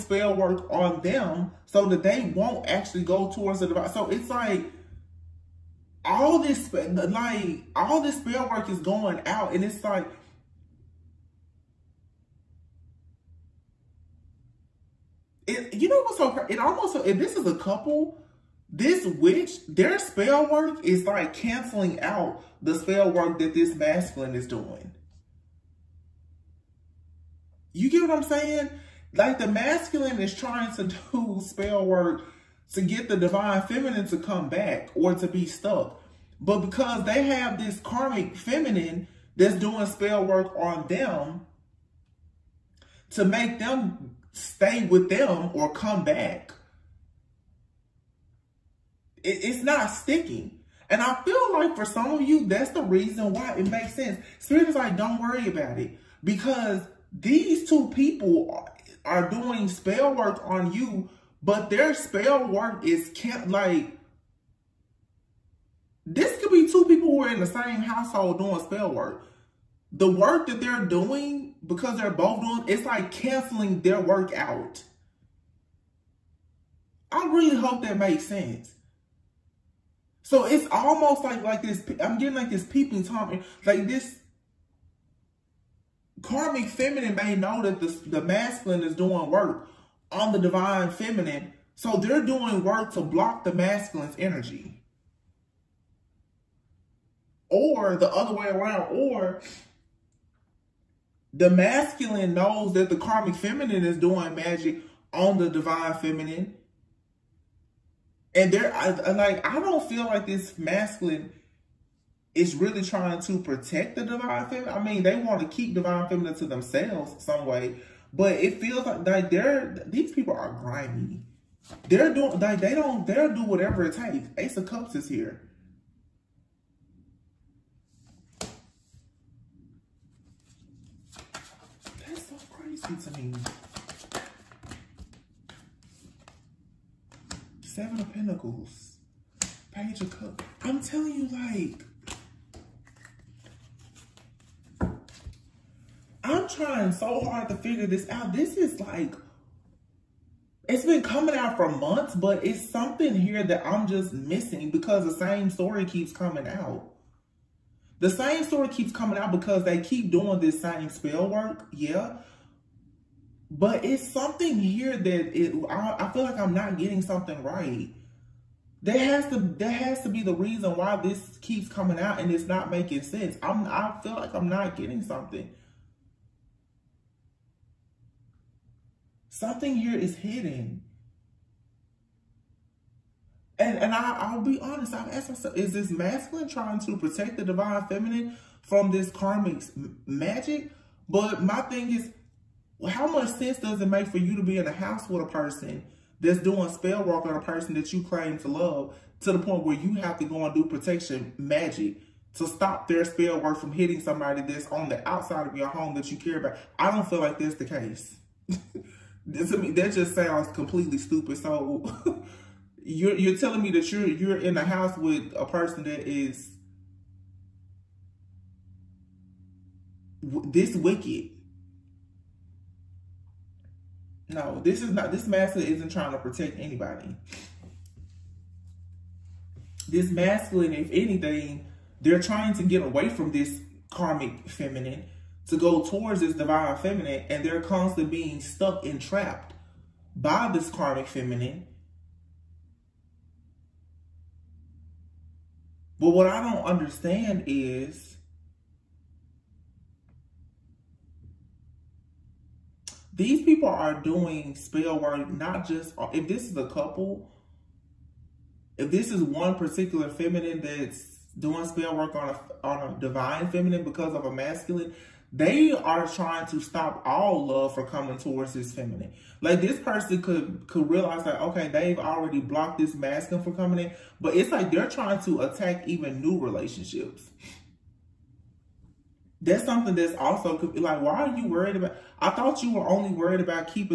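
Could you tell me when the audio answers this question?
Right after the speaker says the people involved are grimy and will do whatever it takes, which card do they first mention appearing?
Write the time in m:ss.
2:04.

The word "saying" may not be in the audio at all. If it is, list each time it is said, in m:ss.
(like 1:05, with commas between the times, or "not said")
0:28.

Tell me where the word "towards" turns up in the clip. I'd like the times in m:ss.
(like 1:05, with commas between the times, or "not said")
0:03, 3:55, 4:28.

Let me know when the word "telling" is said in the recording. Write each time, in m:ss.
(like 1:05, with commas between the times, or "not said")
2:20, 3:33.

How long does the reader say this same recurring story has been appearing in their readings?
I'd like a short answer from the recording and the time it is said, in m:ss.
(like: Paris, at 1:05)
months, at 2:31.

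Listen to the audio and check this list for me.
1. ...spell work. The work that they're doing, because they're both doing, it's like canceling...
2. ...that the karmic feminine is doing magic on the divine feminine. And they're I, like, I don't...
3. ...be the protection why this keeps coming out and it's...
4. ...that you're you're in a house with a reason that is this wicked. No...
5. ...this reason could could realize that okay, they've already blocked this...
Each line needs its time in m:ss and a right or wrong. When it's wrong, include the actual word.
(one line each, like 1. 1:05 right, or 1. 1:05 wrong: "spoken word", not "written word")
1. 1:08 right
2. 1:42 right
3. 2:50 wrong: "reason", not "protection"
4. 3:33 wrong: "person", not "reason"
5. 4:29 wrong: "person", not "reason".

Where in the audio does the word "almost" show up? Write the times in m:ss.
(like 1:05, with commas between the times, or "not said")
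0:16, 1:20.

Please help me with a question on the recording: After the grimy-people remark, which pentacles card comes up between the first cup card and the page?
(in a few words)
Seven of Pentacles.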